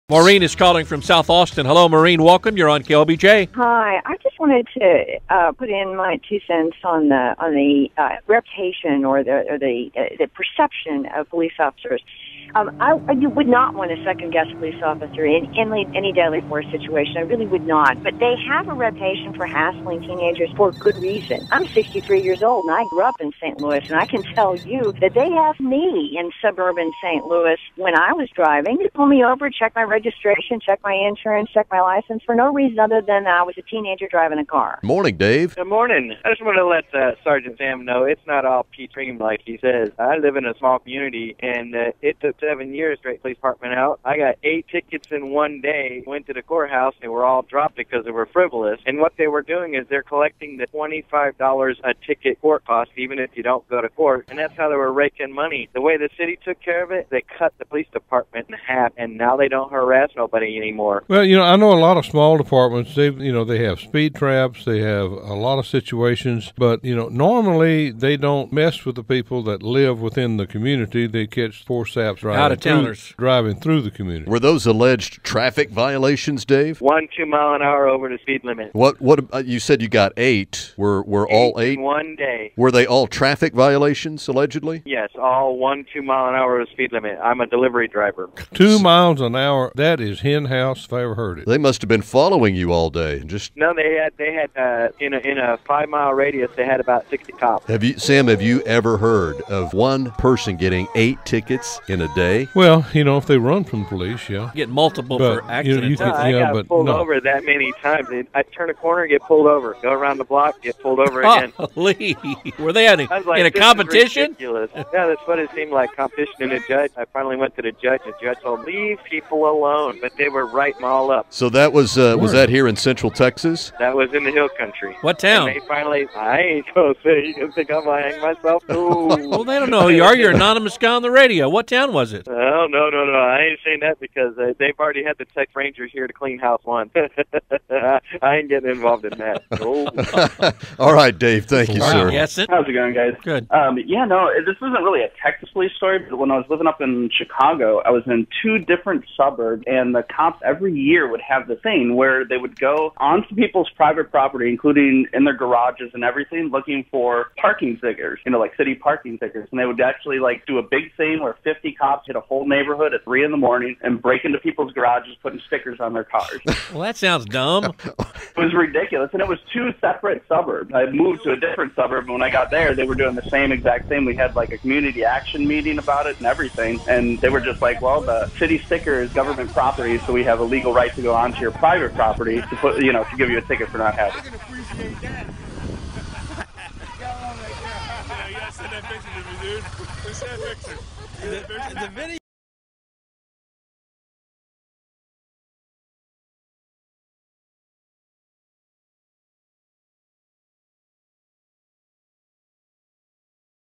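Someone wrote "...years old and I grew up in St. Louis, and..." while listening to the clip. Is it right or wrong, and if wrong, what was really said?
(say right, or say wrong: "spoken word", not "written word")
right.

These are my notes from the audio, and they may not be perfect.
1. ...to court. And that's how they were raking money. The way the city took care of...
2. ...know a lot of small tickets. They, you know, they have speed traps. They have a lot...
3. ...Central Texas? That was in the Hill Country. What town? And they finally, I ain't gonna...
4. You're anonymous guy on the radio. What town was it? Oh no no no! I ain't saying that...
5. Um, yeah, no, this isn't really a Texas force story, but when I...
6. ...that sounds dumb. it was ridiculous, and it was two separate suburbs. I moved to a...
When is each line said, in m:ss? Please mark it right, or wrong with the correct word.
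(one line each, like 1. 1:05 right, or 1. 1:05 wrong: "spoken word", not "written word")
1. 0:53 right
2. 1:01 wrong: "departments", not "tickets"
3. 2:02 right
4. 2:10 right
5. 2:23 wrong: "police", not "force"
6. 2:46 right.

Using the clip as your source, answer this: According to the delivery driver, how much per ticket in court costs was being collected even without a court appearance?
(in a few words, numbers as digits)
$25.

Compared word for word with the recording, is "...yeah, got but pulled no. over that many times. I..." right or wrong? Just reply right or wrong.
right.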